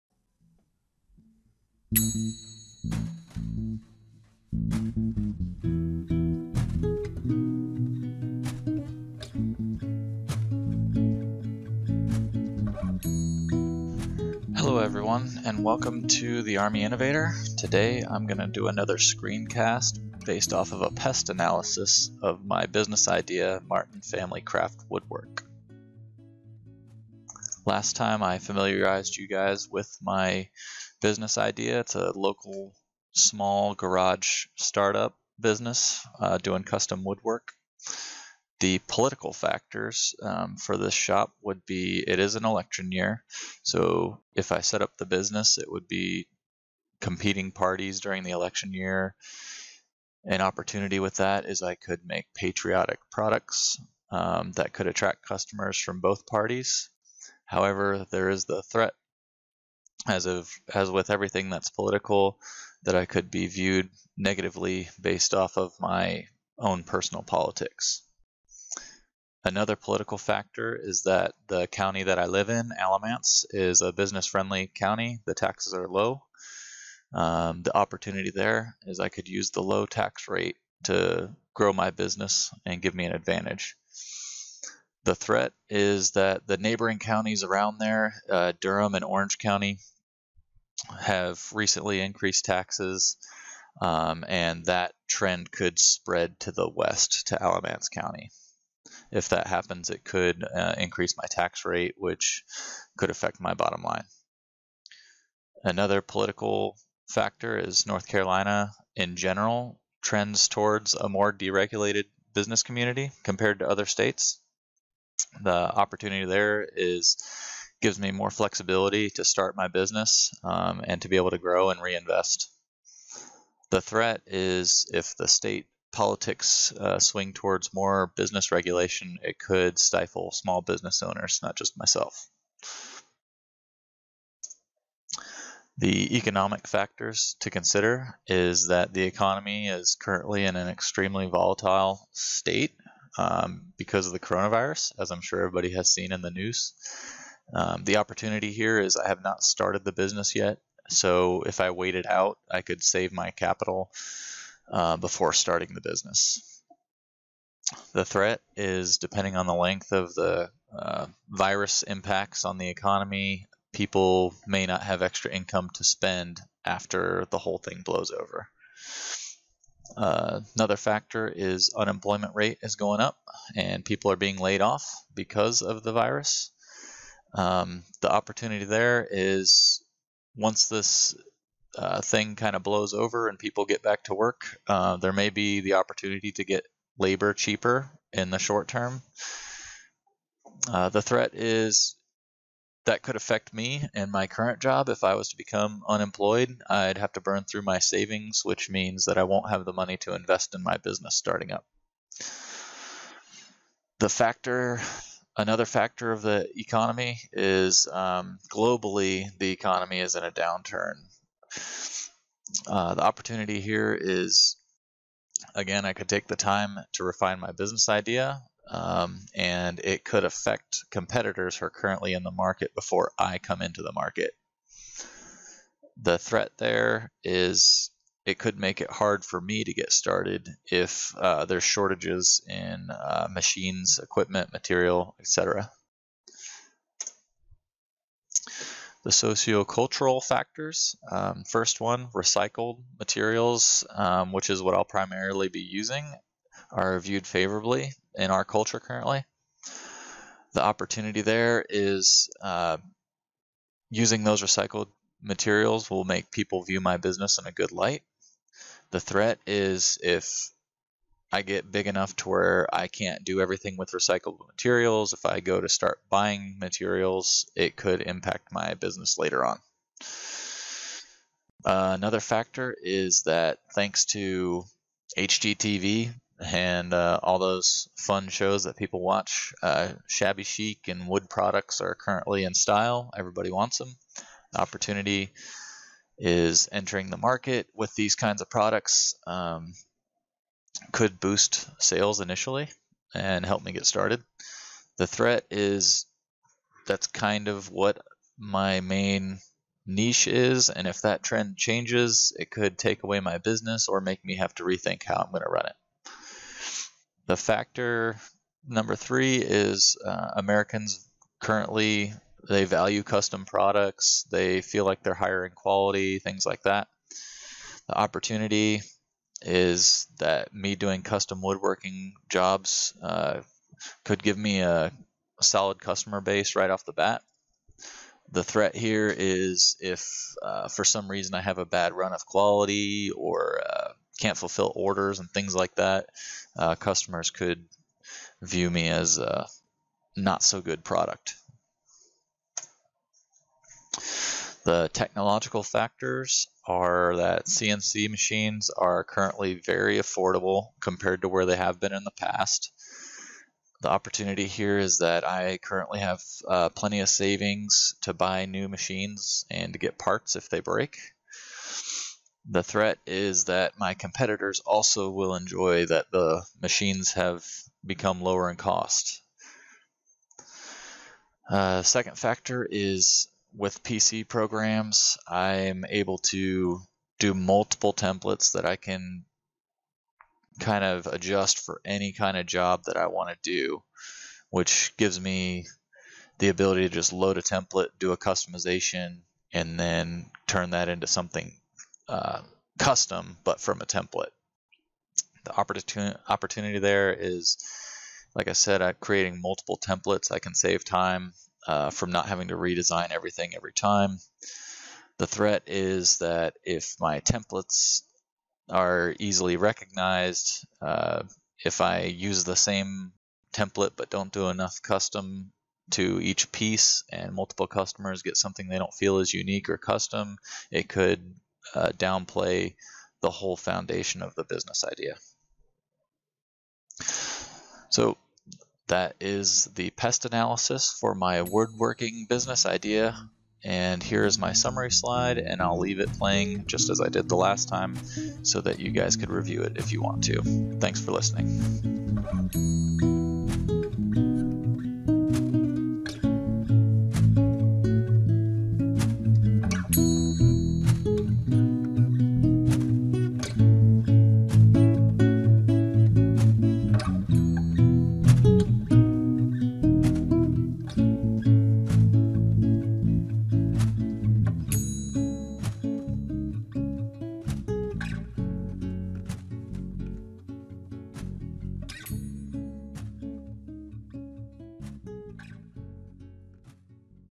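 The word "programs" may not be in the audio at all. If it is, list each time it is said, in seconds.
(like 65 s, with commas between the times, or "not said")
374 s.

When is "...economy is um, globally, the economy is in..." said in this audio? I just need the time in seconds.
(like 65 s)
206 s.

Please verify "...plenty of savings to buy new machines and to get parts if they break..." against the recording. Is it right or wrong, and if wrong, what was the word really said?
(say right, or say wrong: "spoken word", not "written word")
right.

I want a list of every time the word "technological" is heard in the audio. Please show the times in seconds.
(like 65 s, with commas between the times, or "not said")
344 s.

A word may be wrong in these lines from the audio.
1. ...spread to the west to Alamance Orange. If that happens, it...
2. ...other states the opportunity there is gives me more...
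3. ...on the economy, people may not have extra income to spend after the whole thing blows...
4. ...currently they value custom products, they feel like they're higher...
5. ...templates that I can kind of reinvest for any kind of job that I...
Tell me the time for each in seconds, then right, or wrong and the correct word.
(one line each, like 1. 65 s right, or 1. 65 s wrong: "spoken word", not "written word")
1. 95 s wrong: "County", not "Orange"
2. 113 s right
3. 162 s right
4. 311 s right
5. 377 s wrong: "adjust", not "reinvest".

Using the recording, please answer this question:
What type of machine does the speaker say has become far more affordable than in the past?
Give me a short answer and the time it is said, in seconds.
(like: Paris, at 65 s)
CNC machines, at 347 s.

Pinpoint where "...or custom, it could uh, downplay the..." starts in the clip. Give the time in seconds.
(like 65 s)
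419 s.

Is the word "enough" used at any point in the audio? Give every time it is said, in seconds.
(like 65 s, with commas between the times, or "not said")
261 s, 414 s.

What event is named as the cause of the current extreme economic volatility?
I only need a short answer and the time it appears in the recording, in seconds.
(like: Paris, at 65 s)
the coronavirus, at 144 s.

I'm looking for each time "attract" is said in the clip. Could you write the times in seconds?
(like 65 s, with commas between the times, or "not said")
54 s.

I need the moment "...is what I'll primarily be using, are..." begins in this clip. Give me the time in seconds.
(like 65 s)
244 s.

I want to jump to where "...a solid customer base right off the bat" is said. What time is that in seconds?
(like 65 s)
324 s.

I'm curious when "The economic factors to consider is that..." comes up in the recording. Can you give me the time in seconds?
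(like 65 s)
135 s.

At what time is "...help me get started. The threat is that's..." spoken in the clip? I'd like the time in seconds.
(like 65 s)
293 s.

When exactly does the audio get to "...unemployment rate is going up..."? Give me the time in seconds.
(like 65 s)
171 s.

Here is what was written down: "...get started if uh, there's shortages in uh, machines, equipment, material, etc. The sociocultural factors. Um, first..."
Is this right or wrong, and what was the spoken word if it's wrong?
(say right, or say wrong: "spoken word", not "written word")
right.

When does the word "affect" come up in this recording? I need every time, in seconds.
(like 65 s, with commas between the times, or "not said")
103 s, 193 s, 220 s.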